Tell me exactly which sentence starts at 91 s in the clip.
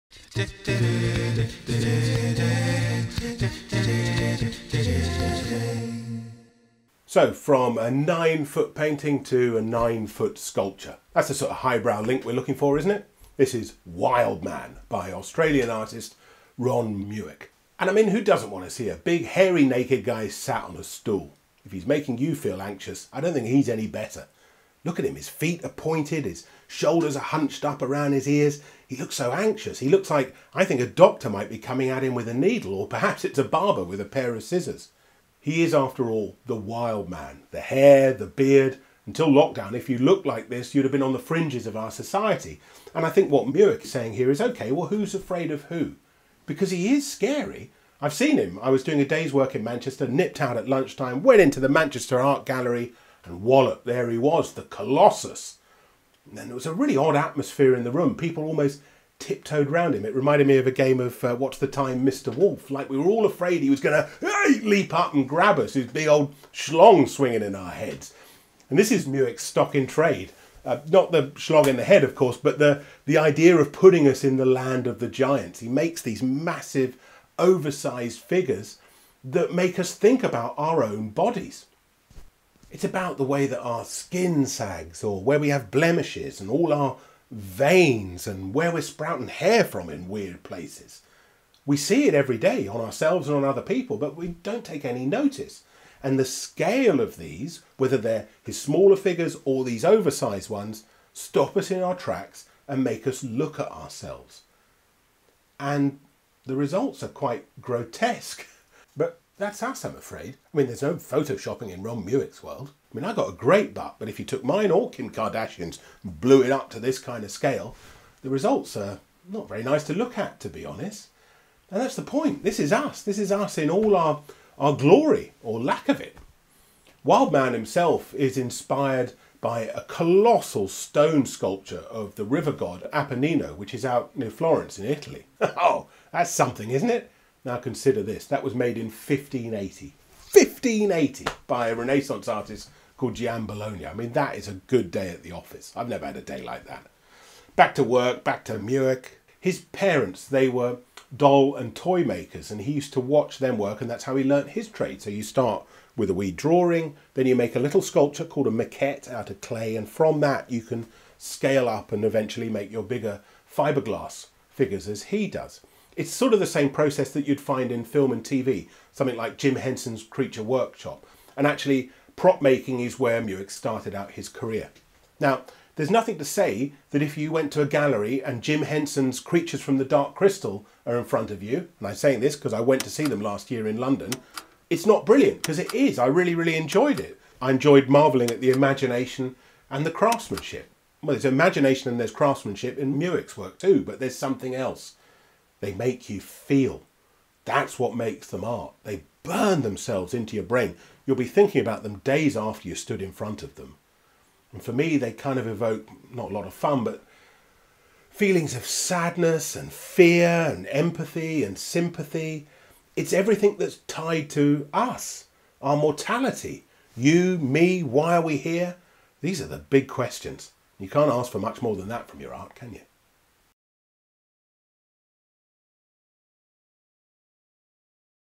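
We see it every day on ourselves and on other people, but we don't take any notice.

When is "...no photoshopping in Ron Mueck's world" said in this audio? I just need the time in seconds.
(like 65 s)
110 s.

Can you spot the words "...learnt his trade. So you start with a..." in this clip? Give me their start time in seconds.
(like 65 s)
154 s.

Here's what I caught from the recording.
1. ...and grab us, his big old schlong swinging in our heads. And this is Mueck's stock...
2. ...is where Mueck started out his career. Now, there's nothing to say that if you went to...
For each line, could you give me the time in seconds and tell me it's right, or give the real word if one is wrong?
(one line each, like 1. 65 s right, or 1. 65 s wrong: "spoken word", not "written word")
1. 65 s right
2. 172 s right.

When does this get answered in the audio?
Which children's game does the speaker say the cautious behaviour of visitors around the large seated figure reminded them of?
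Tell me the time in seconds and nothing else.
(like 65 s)
61 s.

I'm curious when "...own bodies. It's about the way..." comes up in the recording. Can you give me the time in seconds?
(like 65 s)
80 s.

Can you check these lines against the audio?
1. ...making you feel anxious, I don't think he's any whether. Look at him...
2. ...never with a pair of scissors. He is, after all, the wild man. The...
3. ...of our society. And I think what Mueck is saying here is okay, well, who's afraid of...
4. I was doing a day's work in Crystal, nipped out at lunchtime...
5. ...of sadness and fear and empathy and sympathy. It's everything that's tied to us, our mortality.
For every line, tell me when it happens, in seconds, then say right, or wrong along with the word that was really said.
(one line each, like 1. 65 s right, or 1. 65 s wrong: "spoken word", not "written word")
1. 21 s wrong: "better", not "whether"
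2. 33 s wrong: "barber", not "never"
3. 41 s right
4. 48 s wrong: "Manchester", not "Crystal"
5. 208 s right.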